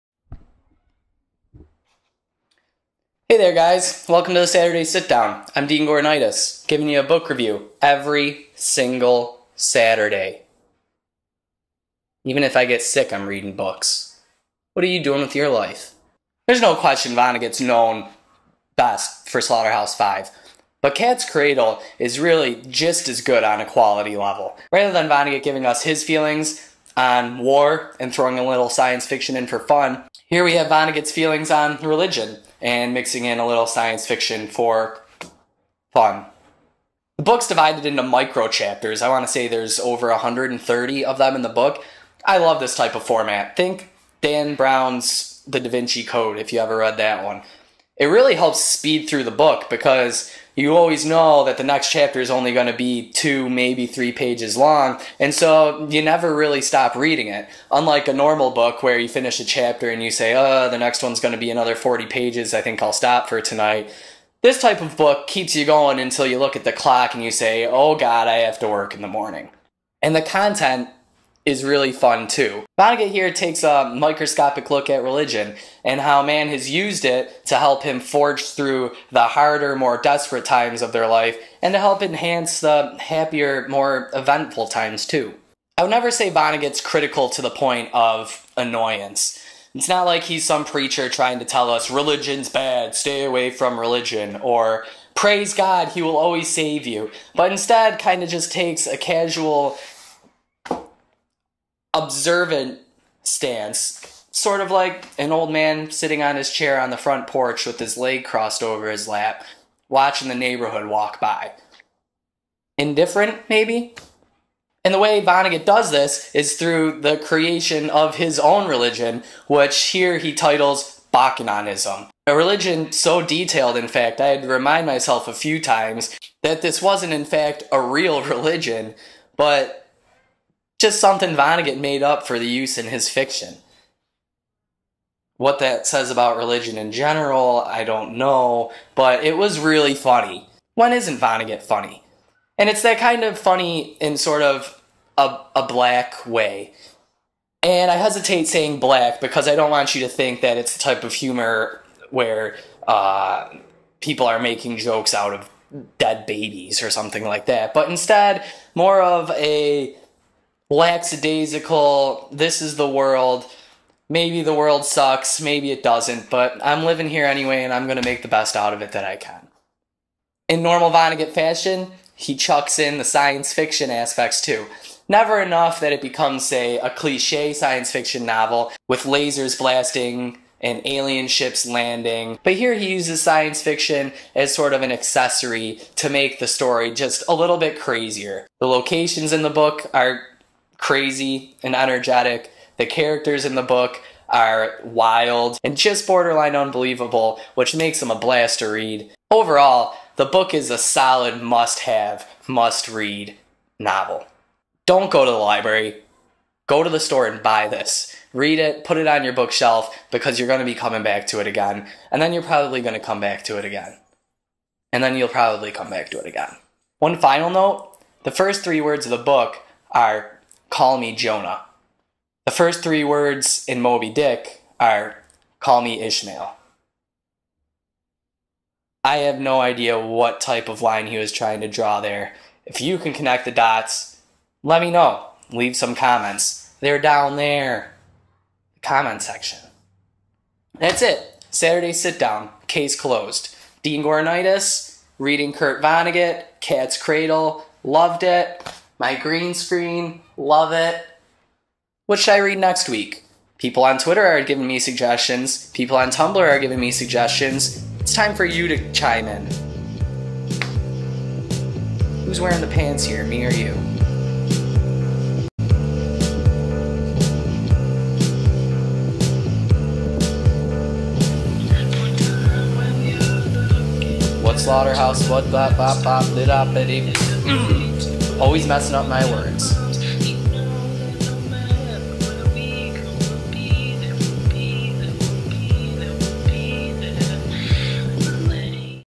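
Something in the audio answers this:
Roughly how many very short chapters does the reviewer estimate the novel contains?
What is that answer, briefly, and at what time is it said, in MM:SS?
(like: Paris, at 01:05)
over 130, at 00:39.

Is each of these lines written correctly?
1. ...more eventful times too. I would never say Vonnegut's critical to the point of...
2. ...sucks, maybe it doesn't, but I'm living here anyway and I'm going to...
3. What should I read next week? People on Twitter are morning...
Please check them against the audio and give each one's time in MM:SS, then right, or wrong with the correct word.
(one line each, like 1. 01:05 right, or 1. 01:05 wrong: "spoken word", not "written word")
1. 01:23 right
2. 02:44 right
3. 04:12 wrong: "giving", not "morning".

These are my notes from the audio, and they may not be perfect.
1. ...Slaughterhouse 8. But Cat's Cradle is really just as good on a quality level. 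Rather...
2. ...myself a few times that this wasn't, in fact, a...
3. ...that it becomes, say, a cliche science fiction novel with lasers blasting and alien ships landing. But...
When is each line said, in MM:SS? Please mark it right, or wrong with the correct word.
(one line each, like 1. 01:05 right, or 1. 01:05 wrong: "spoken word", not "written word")
1. 00:19 wrong: "5", not "8"
2. 02:04 right
3. 02:55 right.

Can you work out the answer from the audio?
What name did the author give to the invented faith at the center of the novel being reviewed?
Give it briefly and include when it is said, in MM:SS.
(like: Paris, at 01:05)
Bokononism, at 02:01.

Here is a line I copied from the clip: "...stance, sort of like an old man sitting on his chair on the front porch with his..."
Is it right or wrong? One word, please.
right.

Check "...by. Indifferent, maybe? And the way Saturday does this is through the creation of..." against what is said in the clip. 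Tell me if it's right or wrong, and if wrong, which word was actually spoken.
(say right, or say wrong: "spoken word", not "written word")
wrong: "Vonnegut", not "Saturday".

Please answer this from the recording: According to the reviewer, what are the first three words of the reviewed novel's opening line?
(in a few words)
Call Me Jonah.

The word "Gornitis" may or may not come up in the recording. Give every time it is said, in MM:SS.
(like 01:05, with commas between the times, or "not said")
00:05, 04:04.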